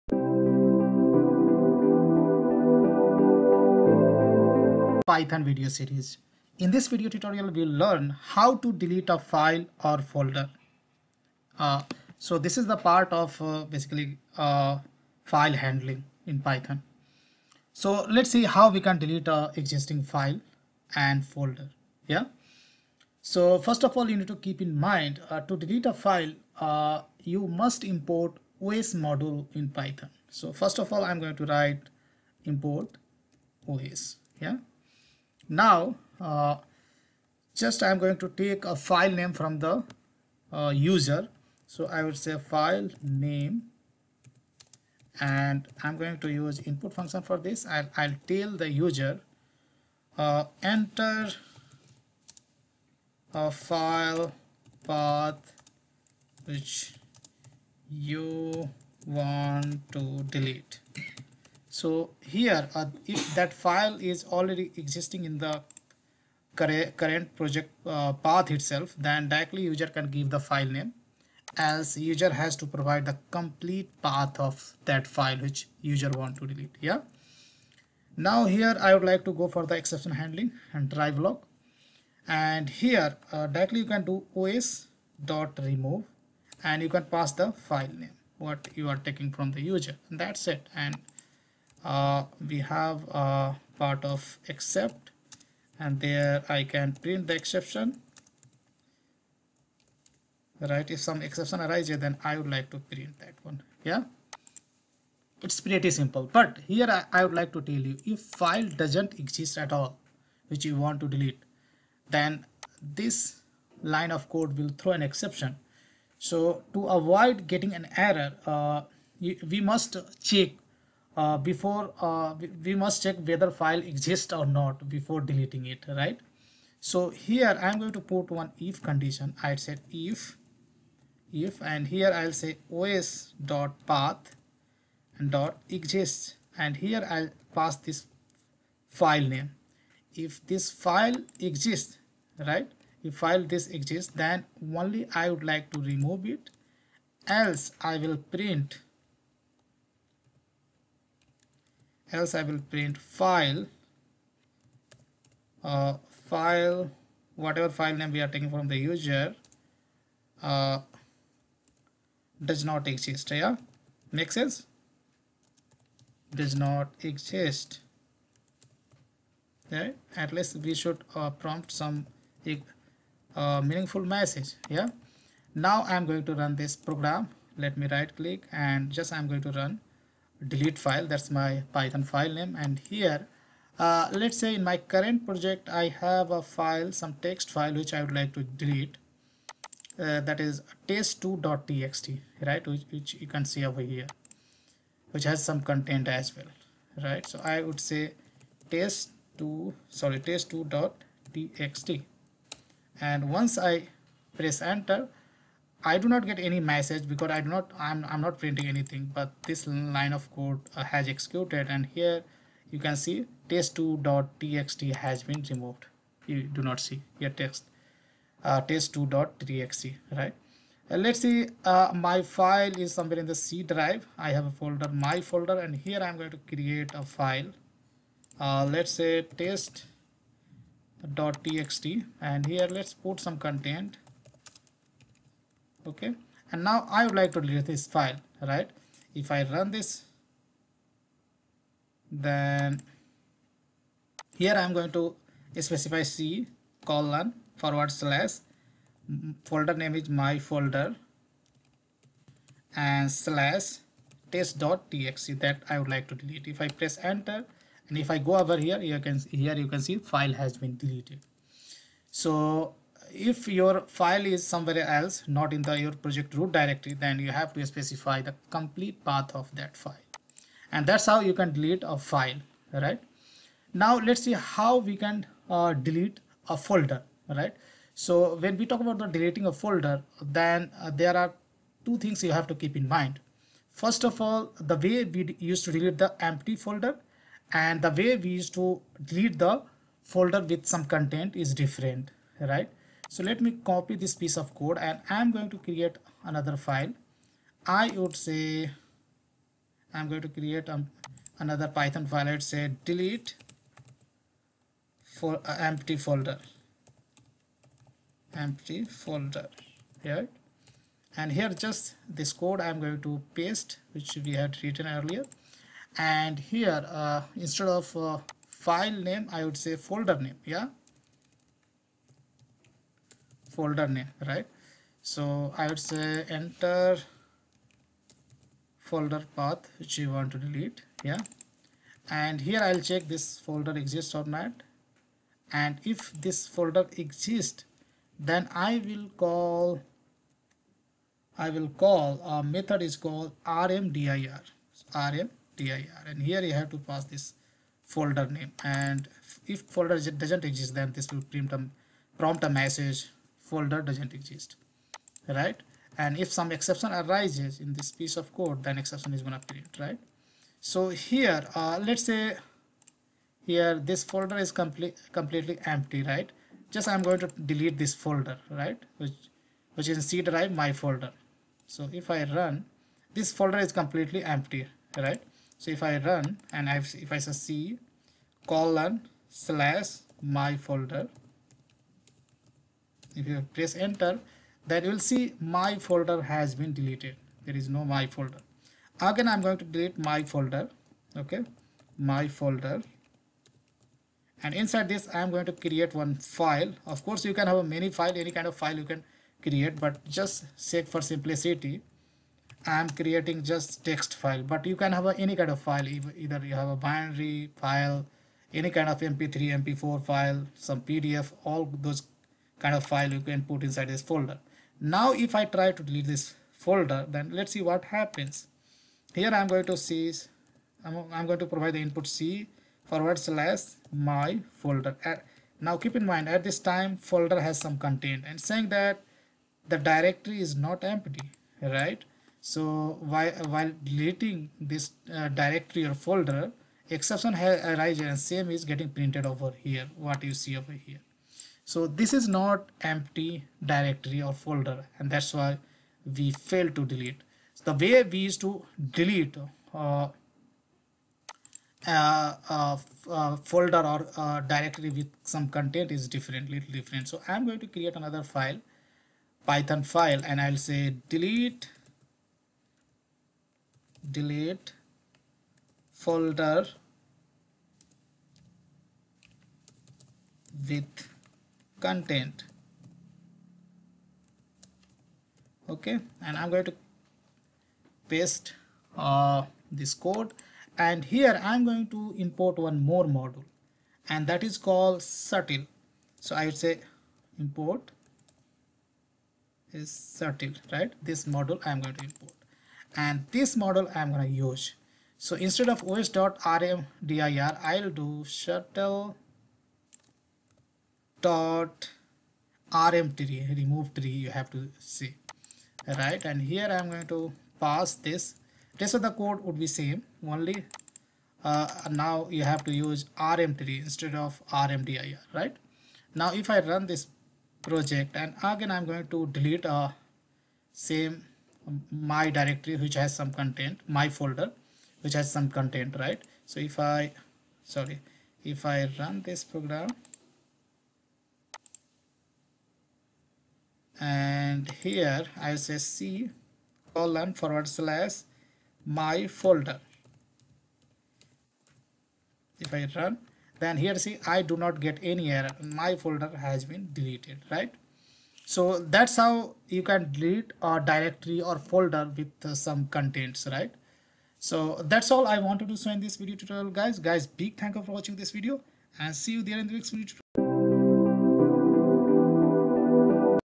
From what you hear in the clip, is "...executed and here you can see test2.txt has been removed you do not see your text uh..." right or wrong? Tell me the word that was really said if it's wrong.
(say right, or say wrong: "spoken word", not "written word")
right.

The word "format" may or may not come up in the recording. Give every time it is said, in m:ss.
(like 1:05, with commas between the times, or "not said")
not said.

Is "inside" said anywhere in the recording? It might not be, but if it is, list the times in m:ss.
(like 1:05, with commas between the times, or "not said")
6:34, 6:53.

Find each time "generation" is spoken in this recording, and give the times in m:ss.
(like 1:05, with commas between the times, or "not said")
not said.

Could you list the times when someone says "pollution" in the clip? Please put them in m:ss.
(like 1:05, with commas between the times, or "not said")
not said.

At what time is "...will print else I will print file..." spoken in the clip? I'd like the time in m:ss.
2:27.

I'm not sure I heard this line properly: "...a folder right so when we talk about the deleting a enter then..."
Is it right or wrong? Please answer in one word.
wrong.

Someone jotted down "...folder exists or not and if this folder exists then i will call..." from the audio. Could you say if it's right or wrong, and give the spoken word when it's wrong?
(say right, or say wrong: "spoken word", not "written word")
right.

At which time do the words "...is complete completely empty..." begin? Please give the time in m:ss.
6:04.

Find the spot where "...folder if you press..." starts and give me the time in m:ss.
6:20.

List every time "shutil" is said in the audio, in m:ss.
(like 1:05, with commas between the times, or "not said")
8:05, 8:10, 8:18.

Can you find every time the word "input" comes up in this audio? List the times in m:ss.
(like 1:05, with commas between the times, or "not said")
0:46, 7:01.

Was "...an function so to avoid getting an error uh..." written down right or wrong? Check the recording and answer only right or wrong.
wrong.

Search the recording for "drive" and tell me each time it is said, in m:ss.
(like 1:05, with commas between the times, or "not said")
3:43, 6:10.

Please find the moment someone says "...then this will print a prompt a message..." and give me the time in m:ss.
5:50.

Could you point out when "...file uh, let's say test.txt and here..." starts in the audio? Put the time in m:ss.
3:47.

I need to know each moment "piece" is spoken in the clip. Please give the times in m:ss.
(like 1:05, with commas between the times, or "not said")
4:54, 5:58.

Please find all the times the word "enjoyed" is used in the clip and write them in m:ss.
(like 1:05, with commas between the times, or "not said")
not said.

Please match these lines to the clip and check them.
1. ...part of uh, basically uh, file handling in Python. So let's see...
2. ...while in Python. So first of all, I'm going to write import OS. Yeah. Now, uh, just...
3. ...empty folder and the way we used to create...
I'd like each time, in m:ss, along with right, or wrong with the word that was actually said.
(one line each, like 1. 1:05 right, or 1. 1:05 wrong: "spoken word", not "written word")
1. 0:12 right
2. 0:29 wrong: "module", not "while"
3. 4:46 wrong: "delete", not "create".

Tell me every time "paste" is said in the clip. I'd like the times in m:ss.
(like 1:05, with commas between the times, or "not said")
5:13, 7:58.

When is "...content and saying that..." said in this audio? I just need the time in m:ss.
7:07.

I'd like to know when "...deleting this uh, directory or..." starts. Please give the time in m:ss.
7:13.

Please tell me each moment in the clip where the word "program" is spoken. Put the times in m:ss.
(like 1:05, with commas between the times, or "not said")
2:56, 8:49.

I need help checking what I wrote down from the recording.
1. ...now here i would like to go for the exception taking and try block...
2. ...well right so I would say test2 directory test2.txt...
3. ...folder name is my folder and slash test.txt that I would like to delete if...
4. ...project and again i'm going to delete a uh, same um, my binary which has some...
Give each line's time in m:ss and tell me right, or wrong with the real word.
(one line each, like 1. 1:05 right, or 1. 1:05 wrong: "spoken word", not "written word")
1. 1:18 wrong: "handling", not "taking"
2. 3:16 wrong: "sorry", not "directory"
3. 4:09 right
4. 8:37 wrong: "directory", not "binary".